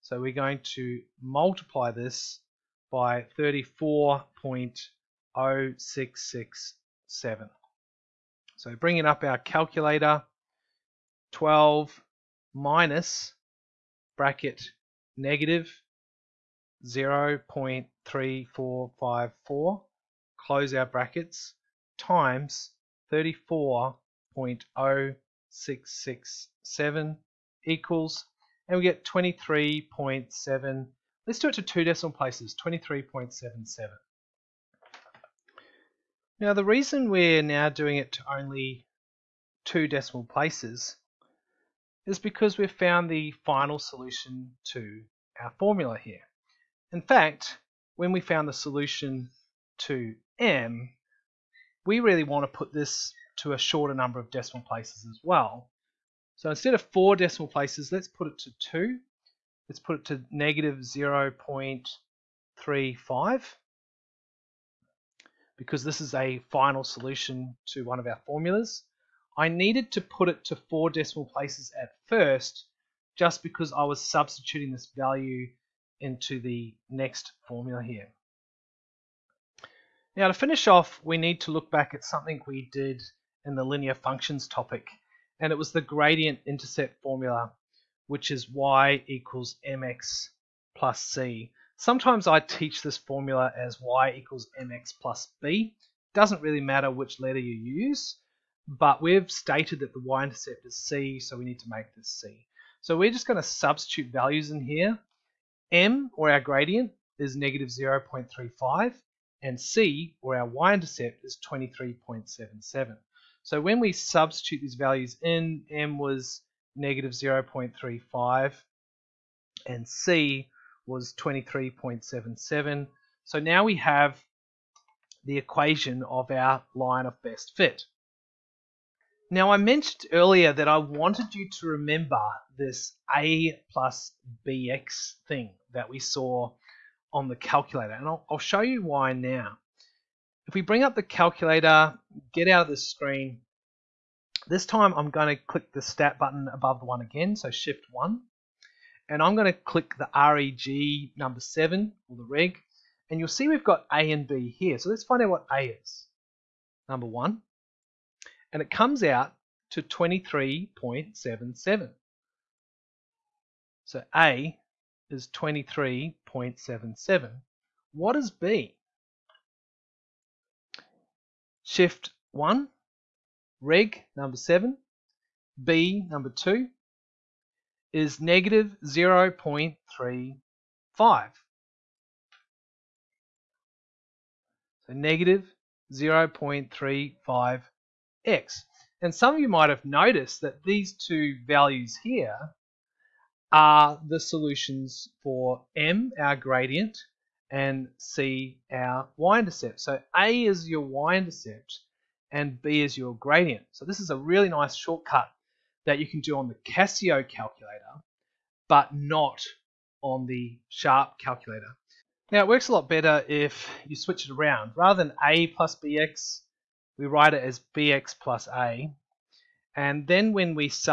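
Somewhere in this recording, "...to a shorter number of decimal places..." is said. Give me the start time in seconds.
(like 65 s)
53 s.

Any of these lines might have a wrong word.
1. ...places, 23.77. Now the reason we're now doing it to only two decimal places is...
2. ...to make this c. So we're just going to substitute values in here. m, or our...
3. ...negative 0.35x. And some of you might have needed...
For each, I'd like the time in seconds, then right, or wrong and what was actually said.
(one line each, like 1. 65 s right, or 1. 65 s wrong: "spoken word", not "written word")
1. 32 s right
2. 101 s right
3. 184 s wrong: "noticed", not "needed".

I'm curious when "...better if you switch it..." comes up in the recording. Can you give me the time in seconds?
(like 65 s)
212 s.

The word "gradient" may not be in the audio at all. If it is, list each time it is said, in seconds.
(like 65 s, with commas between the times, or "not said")
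85 s, 106 s, 196 s, 203 s.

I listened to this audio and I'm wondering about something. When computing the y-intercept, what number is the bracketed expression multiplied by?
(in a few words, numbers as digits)
34.0667.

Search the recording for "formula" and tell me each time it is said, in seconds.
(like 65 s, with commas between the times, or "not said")
45 s, 68 s, 77 s, 87 s, 92 s.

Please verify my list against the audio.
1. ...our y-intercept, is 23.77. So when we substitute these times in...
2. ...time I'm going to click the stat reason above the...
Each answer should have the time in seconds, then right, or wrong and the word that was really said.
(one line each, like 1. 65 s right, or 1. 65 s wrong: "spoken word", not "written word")
1. 110 s wrong: "values", not "times"
2. 144 s wrong: "button", not "reason".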